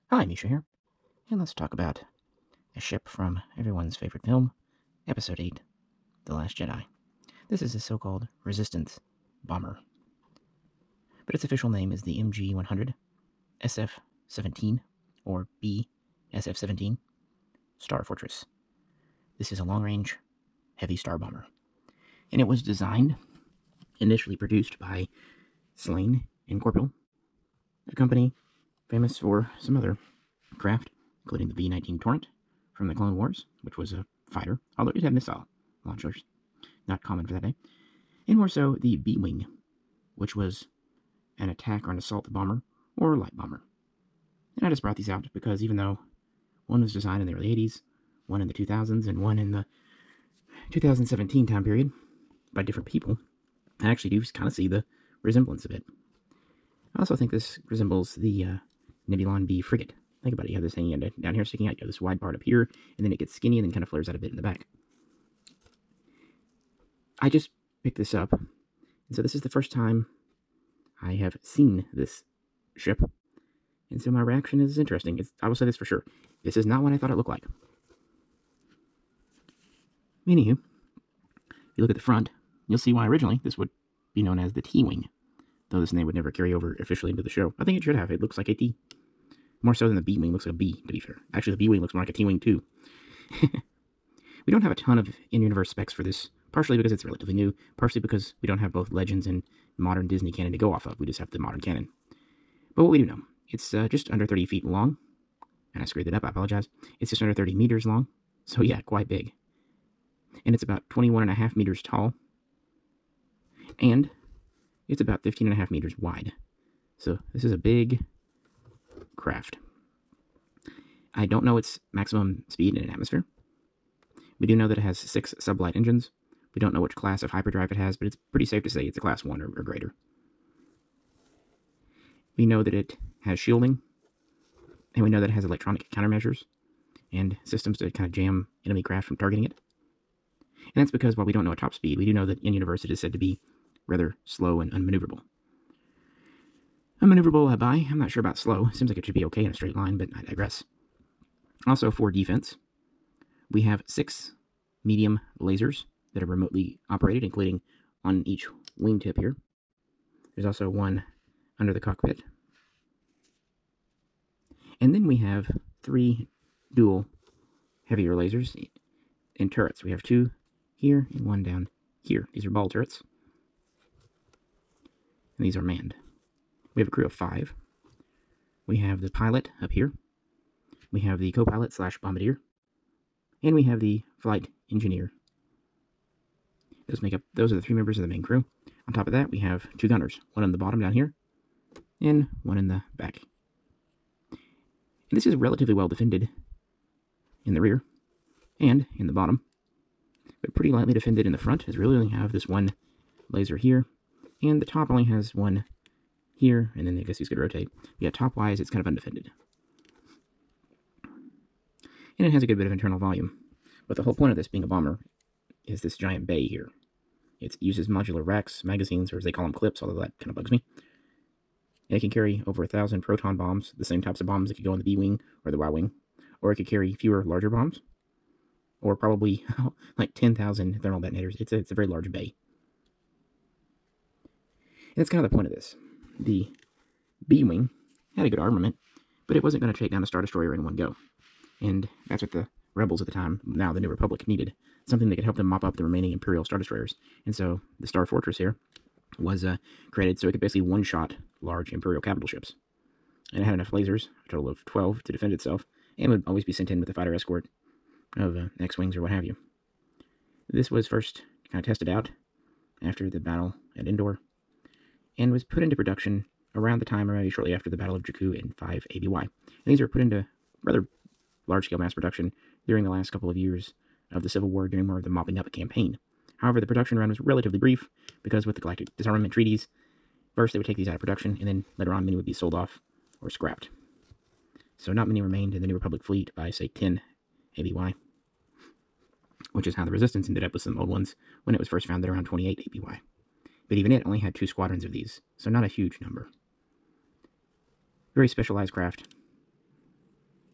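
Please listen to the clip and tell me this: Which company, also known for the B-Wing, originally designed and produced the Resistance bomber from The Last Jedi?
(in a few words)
Slayn and Korpil.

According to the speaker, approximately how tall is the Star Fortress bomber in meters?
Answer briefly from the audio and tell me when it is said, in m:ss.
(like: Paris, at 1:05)
21.5 meters, at 1:50.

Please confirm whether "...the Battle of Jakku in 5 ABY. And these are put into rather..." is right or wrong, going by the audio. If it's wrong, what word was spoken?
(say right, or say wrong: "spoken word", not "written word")
right.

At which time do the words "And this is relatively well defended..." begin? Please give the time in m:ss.
3:15.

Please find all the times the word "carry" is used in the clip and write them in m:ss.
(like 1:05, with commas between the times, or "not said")
1:26, 3:42, 3:46.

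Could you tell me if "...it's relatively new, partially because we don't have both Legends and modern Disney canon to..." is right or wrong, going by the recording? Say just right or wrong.
right.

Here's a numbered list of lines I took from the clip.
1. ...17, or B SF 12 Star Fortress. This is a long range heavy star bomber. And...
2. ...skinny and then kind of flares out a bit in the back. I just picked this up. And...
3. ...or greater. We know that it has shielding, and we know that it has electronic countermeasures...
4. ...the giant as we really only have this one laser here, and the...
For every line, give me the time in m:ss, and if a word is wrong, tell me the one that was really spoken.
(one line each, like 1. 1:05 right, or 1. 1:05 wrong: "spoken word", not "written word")
1. 0:14 wrong: "17", not "12"
2. 1:03 right
3. 2:09 right
4. 3:21 wrong: "front", not "giant".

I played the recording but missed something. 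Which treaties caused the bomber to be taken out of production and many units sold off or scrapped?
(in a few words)
Galactic Disarmament Treaties.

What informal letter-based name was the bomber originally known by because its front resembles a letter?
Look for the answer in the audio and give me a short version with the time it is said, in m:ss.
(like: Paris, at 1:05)
T-Wing, at 1:24.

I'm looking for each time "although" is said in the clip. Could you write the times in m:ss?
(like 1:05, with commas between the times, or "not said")
0:34, 3:39.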